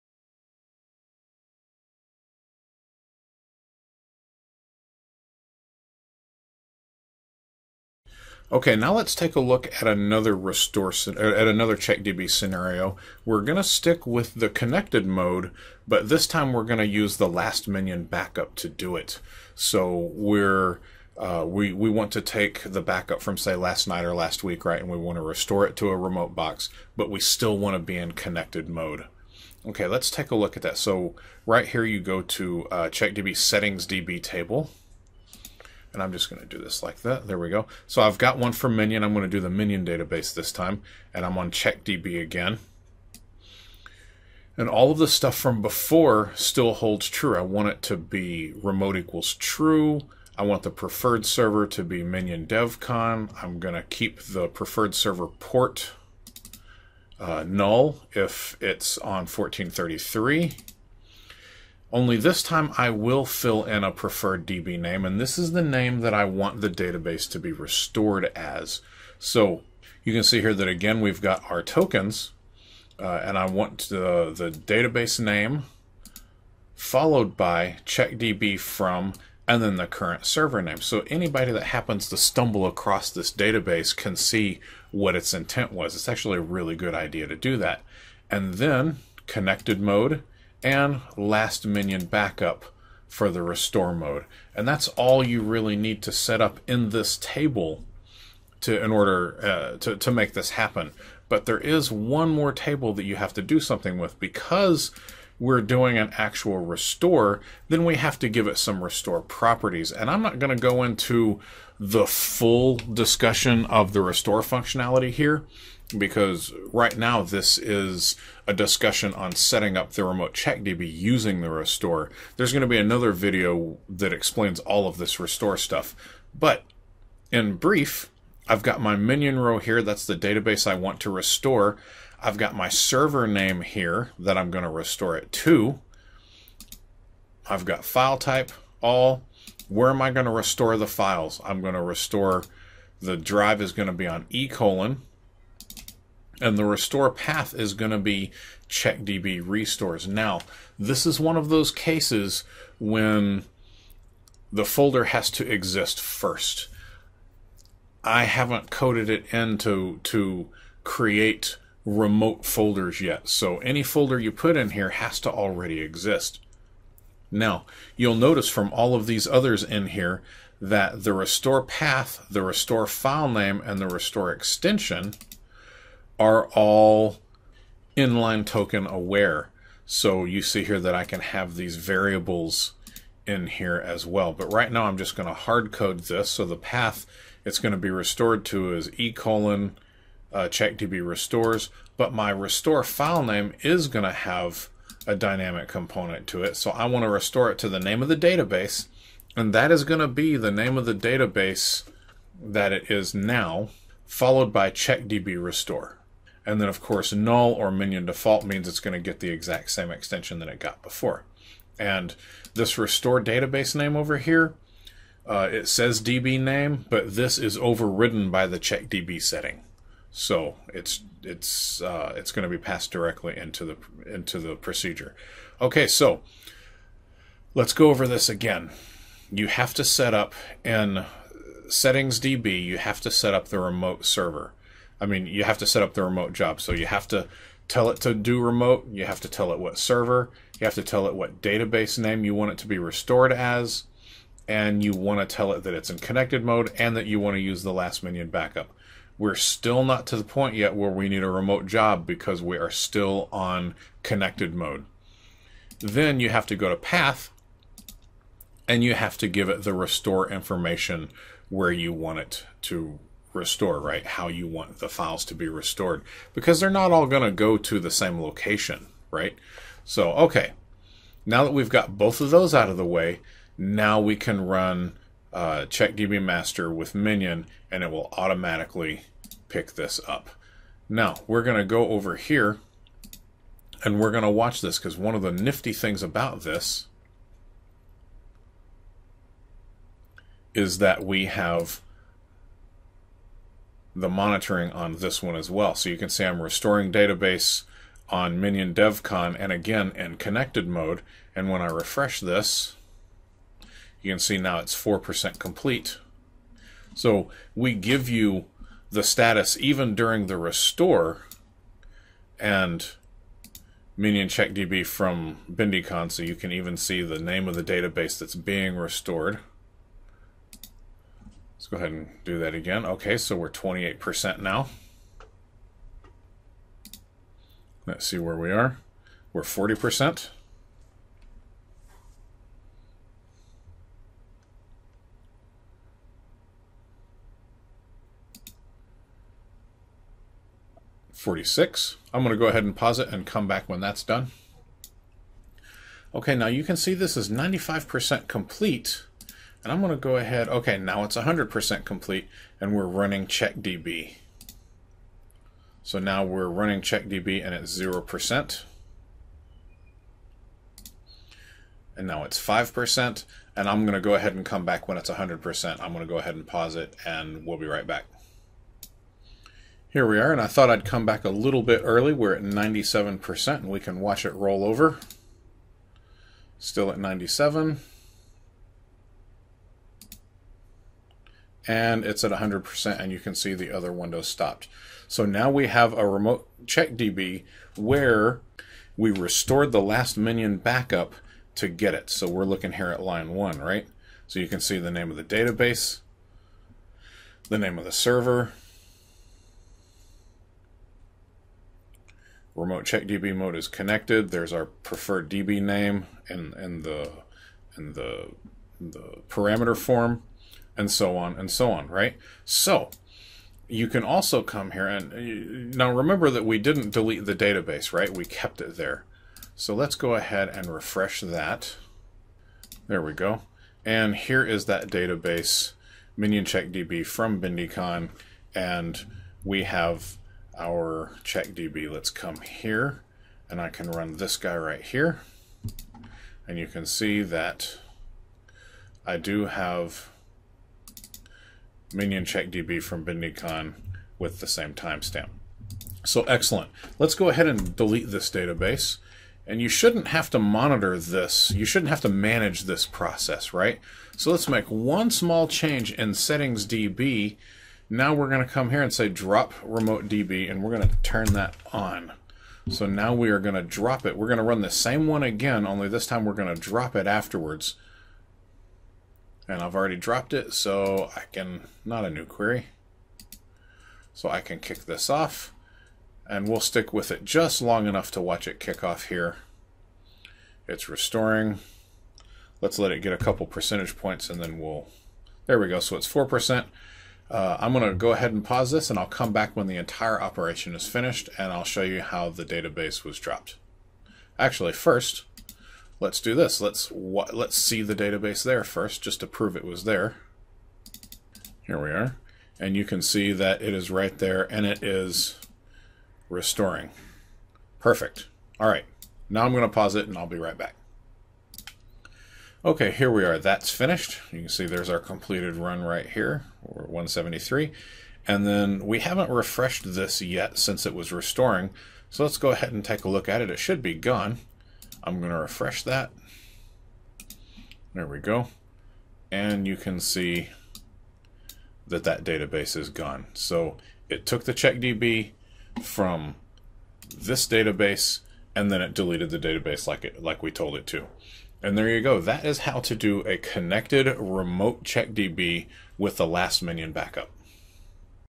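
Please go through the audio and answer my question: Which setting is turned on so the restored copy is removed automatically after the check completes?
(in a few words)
drop remote DB.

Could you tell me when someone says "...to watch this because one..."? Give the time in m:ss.
4:44.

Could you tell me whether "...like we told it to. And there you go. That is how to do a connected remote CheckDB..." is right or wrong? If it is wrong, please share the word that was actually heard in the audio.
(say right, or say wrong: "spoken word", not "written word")
right.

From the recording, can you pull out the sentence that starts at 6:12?
We're at 97%, and we can watch it roll over.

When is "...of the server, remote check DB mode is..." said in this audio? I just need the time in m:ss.
6:37.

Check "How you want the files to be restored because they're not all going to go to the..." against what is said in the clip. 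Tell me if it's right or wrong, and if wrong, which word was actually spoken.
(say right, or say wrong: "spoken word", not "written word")
right.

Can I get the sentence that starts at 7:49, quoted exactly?
And I've already dropped it, so I can, not a new query.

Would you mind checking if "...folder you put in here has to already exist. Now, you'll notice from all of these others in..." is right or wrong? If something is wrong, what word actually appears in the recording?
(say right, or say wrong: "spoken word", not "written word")
right.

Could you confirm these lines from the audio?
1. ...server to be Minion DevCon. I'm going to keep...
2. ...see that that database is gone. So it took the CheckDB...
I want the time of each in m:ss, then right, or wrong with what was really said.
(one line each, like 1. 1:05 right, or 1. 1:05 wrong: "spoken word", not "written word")
1. 0:51 right
2. 8:49 right.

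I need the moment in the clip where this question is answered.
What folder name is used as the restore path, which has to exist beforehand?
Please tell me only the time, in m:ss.
2:28.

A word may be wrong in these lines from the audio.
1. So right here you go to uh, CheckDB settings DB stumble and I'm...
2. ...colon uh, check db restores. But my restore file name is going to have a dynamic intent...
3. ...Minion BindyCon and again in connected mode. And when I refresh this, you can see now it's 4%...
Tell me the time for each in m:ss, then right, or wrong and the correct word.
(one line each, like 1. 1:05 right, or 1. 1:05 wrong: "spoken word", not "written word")
1. 0:30 wrong: "table", not "stumble"
2. 3:09 wrong: "component", not "intent"
3. 4:58 wrong: "DevCon", not "BindyCon".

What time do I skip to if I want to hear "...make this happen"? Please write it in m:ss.
1:40.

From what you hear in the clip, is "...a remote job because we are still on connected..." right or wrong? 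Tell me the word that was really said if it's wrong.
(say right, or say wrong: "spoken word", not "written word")
right.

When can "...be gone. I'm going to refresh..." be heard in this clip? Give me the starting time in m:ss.
8:43.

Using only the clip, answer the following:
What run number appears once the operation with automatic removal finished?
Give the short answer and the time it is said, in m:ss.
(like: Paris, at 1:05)
173, at 8:36.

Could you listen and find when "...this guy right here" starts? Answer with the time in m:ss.
7:14.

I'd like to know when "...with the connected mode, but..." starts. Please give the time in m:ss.
0:14.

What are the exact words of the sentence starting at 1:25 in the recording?
It's actually a really good idea to do that.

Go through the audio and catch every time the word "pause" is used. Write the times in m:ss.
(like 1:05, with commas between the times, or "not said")
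5:42, 6:06, 8:08, 8:29.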